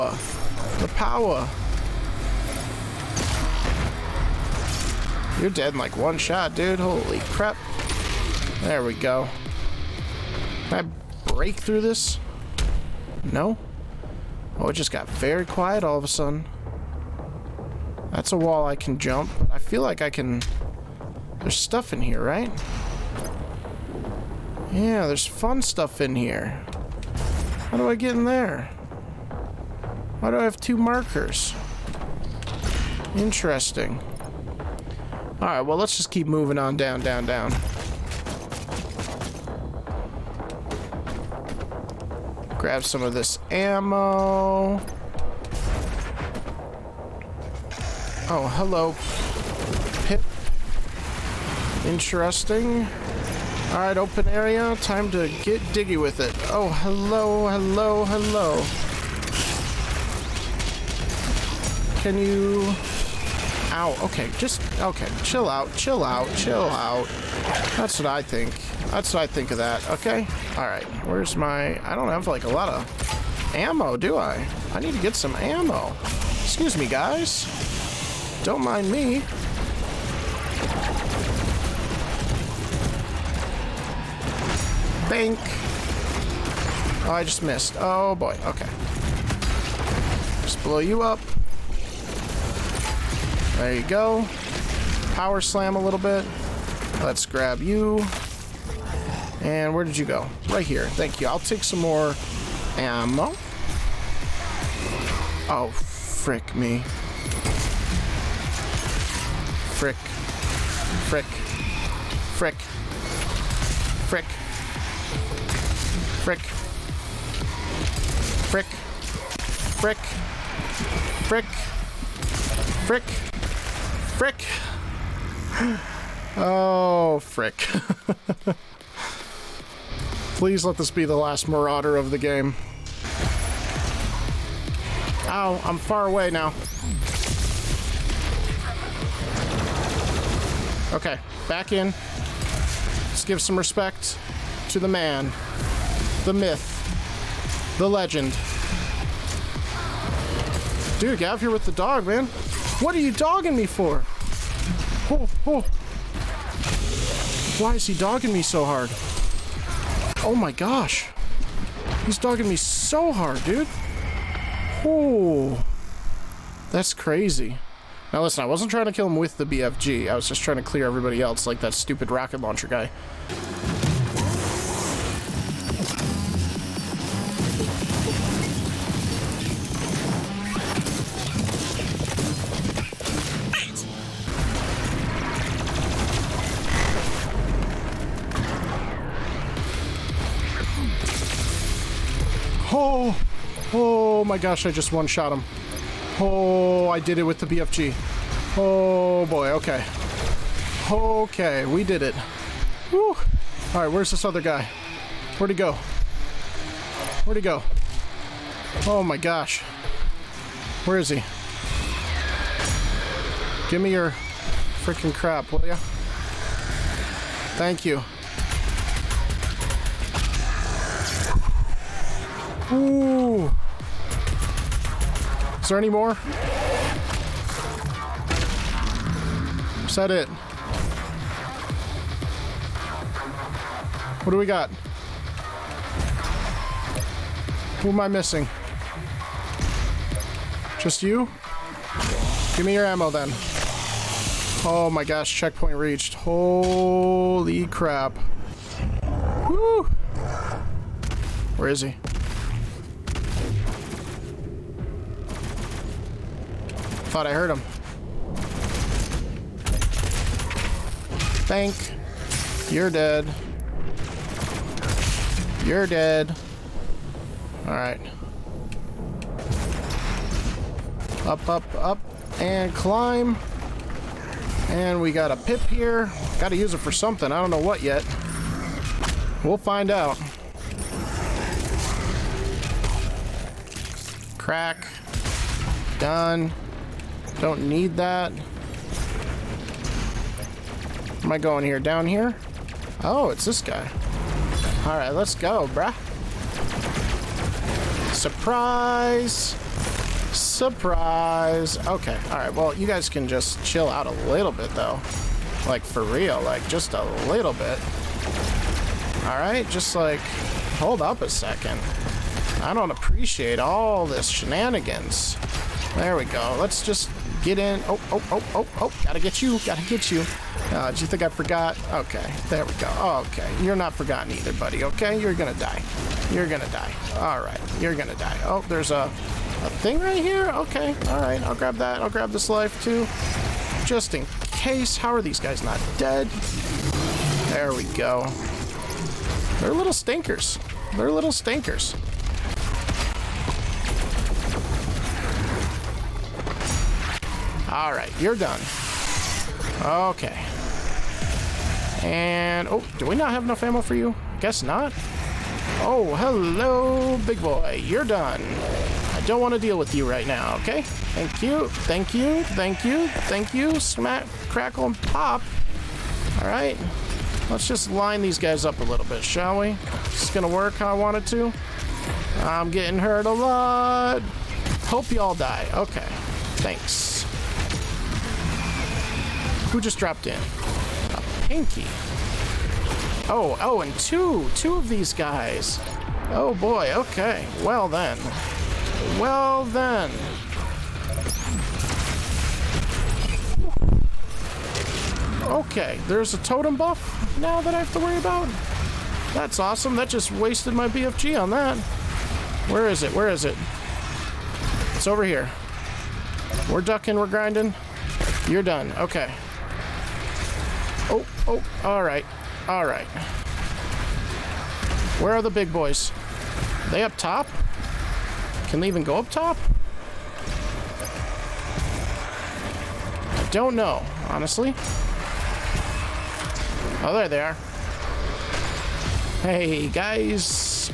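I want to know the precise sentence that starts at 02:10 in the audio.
Please let this be the last marauder of the game.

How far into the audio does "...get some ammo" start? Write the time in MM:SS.
01:15.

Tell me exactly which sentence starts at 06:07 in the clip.
Let's just line these guys up a little bit, shall we?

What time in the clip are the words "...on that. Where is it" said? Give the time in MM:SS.
06:41.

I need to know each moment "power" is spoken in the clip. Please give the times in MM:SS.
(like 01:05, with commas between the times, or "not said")
00:00, 01:35.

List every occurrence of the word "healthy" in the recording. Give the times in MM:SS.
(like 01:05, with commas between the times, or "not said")
not said.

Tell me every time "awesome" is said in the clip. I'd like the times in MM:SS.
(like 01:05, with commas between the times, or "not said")
06:39.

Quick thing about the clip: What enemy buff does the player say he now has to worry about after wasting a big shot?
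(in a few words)
Totem buff.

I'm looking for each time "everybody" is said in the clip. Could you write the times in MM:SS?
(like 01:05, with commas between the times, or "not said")
02:50.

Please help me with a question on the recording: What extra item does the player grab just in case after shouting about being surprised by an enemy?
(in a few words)
Life.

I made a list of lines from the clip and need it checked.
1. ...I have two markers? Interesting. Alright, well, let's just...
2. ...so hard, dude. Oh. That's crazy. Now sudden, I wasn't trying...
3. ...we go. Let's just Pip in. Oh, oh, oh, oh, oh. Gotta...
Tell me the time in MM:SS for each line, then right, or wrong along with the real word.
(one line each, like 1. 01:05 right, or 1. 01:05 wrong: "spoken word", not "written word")
1. 00:30 right
2. 02:42 wrong: "listen", not "sudden"
3. 05:16 wrong: "Get", not "Pip".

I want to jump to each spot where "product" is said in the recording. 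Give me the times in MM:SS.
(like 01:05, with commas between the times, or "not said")
not said.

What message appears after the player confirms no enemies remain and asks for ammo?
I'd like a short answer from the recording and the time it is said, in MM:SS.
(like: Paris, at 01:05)
Checkpoint reached, at 04:05.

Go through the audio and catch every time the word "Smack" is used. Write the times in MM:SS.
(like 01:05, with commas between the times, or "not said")
06:03.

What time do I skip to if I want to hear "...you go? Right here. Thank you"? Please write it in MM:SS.
01:39.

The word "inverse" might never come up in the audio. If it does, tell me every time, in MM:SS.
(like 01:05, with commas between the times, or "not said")
not said.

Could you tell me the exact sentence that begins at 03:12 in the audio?
Oh, oh my gosh, I just one-shot him.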